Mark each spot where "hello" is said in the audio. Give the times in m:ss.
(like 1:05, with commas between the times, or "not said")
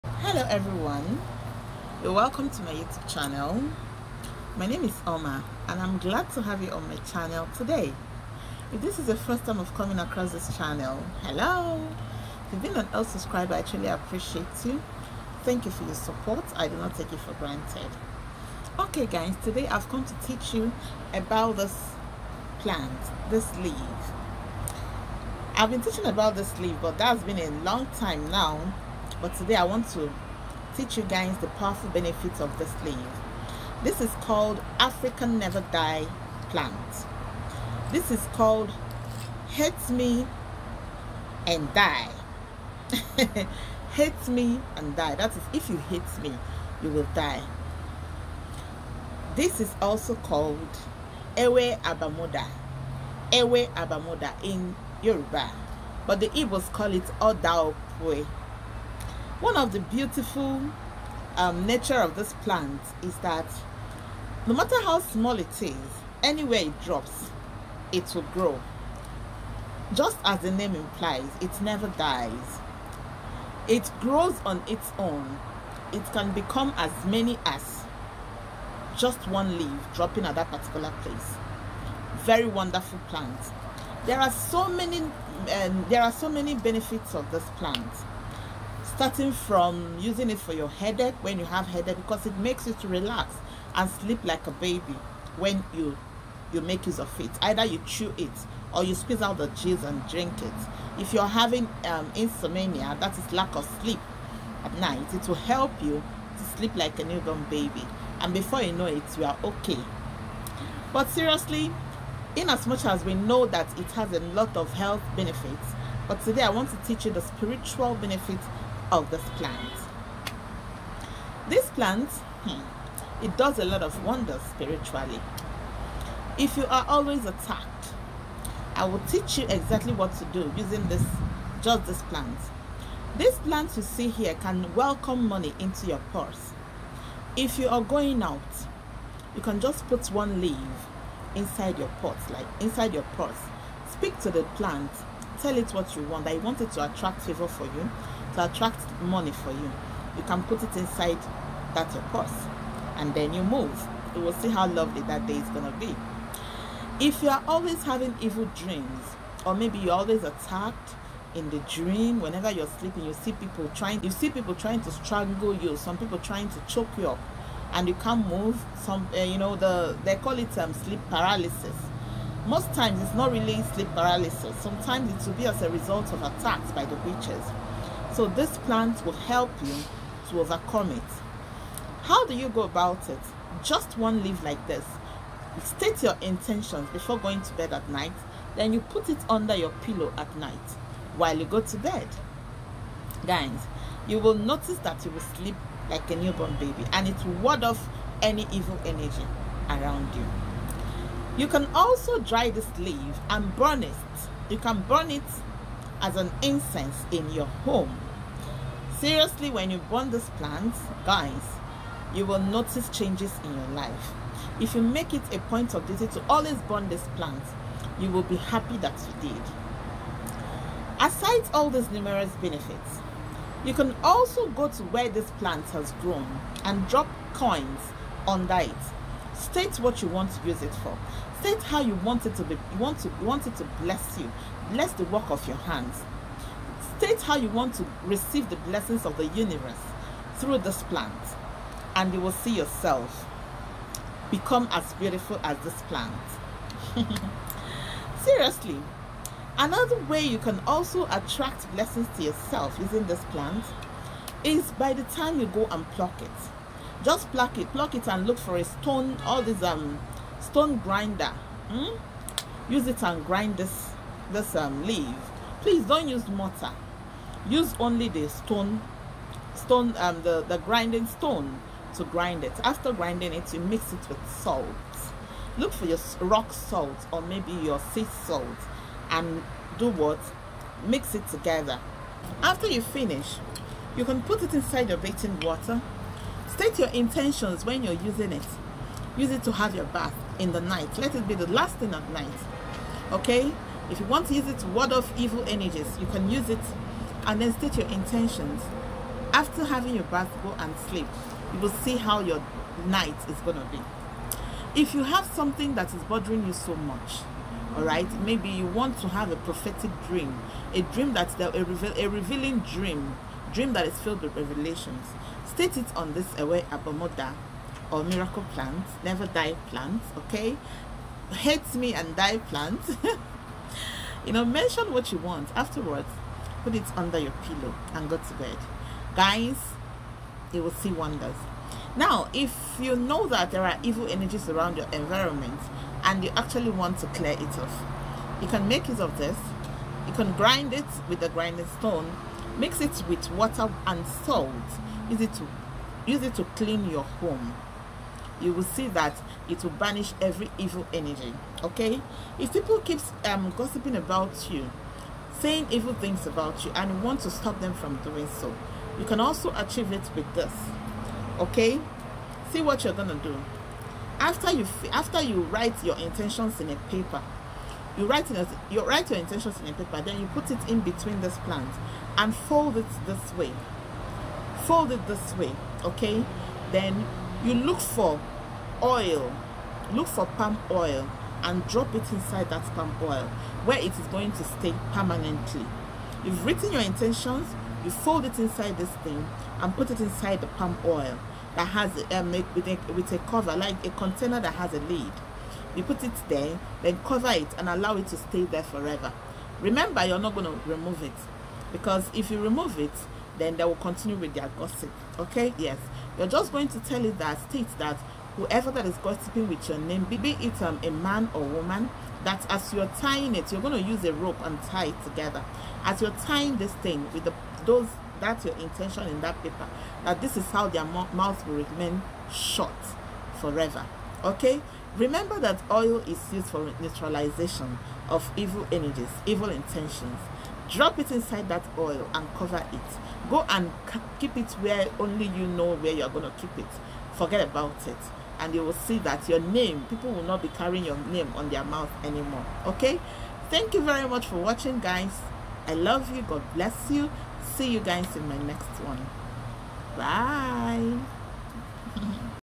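0:00, 0:11.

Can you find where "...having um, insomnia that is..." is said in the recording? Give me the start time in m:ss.
1:41.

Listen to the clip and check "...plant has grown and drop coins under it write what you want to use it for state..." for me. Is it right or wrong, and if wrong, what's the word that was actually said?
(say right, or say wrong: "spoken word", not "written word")
wrong: "state", not "write".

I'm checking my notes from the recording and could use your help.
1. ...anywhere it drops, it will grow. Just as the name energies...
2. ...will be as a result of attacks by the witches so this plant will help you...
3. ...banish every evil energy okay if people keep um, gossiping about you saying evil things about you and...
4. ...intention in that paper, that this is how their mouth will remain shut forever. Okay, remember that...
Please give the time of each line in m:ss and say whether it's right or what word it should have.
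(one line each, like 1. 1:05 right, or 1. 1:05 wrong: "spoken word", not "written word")
1. 1:06 wrong: "implies", not "energies"
2. 2:55 right
3. 5:49 right
4. 6:58 right.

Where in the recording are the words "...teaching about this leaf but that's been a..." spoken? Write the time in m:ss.
0:25.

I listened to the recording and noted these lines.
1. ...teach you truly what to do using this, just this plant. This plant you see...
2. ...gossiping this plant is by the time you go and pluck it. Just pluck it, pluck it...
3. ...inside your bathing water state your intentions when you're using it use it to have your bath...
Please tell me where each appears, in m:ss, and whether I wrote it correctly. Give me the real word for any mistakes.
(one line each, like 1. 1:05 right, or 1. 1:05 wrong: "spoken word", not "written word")
1. 2:09 wrong: "exactly", not "truly"
2. 4:12 wrong: "using", not "gossiping"
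3. 4:44 right.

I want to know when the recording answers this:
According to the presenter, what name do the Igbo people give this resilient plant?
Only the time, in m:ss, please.
0:57.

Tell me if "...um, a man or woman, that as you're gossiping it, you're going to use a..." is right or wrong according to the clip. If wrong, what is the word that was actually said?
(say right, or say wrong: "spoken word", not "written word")
wrong: "tying", not "gossiping".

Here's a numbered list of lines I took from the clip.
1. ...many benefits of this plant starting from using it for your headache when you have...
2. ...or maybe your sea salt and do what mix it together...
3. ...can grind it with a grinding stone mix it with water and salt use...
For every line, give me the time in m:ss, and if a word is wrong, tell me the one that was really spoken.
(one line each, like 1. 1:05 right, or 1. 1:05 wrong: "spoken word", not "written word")
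1. 1:26 right
2. 4:37 right
3. 5:40 right.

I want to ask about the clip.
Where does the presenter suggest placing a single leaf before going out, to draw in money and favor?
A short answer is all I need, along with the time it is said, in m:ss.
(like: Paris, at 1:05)
Inside your purse, at 2:22.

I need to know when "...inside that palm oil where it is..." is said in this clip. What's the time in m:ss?
6:22.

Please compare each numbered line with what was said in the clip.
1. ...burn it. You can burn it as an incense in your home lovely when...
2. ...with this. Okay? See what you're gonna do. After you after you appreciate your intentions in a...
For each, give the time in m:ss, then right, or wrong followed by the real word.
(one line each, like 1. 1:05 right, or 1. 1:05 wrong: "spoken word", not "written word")
1. 3:23 wrong: "seriously", not "lovely"
2. 6:00 wrong: "write", not "appreciate".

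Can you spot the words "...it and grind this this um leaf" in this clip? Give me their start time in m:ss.
4:22.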